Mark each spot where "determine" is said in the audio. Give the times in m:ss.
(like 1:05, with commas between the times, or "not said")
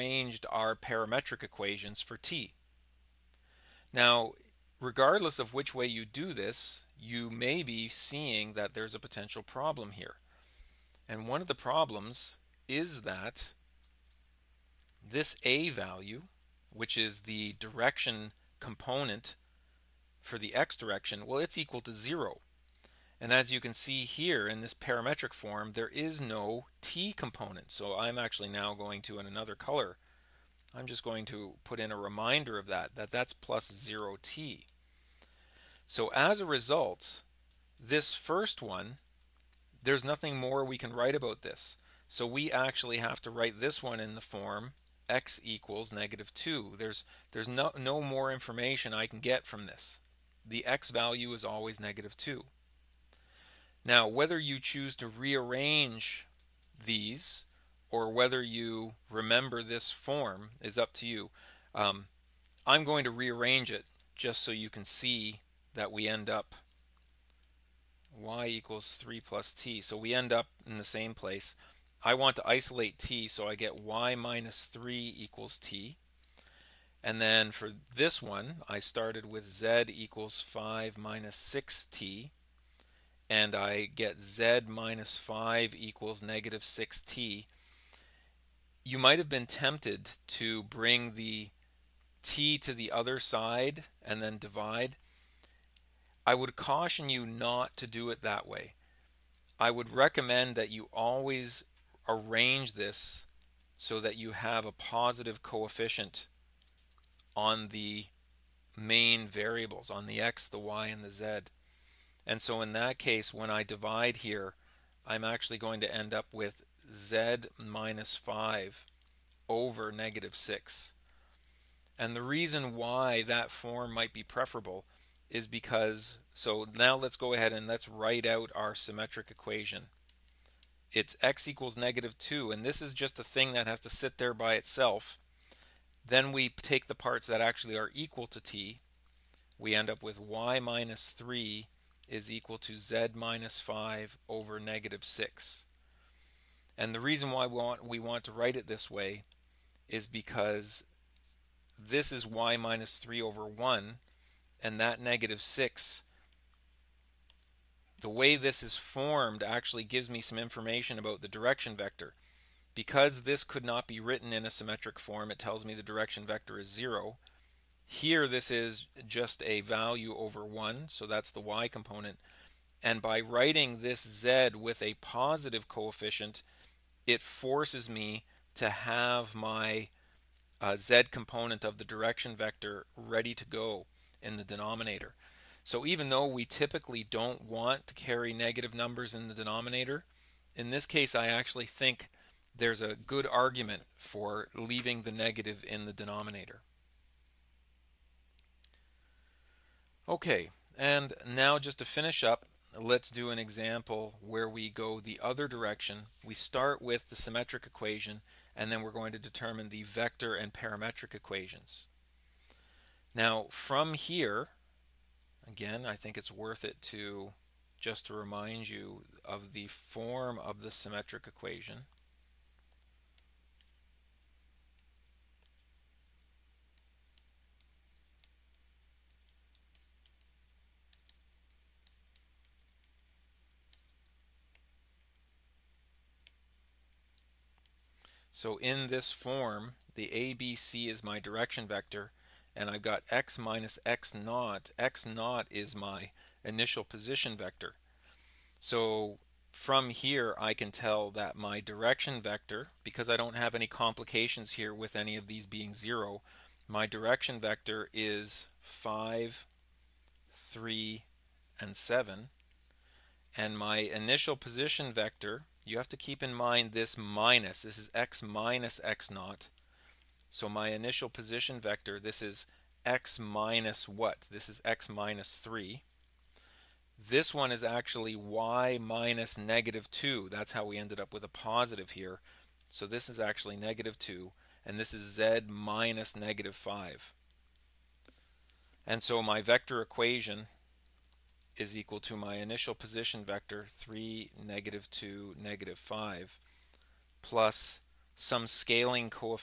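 3:29.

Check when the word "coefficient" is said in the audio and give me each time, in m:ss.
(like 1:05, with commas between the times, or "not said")
1:45, 2:55.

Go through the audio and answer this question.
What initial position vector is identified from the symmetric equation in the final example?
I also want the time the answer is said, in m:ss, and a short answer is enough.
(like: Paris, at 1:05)
3, -2, -5, at 4:53.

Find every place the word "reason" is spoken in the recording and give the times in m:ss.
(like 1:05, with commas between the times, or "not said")
2:02, 2:26.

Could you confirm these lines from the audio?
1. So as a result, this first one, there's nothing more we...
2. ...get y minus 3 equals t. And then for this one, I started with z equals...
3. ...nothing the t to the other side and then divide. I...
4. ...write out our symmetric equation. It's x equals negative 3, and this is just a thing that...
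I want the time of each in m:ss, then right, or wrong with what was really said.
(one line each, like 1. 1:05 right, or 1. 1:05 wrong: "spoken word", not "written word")
1. 0:35 right
2. 1:13 right
3. 1:30 wrong: "bring", not "nothing"
4. 2:07 wrong: "2", not "3".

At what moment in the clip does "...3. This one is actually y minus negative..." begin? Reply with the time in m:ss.
4:35.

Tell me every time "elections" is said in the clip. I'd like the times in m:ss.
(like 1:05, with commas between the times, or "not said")
not said.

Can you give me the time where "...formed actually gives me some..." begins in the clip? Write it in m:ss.
2:38.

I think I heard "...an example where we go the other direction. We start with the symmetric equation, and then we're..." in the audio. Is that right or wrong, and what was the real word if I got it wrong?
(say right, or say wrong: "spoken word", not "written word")
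right.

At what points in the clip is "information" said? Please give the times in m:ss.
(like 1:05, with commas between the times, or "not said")
0:48, 2:40.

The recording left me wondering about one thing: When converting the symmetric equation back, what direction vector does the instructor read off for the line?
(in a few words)
5, 3, 7.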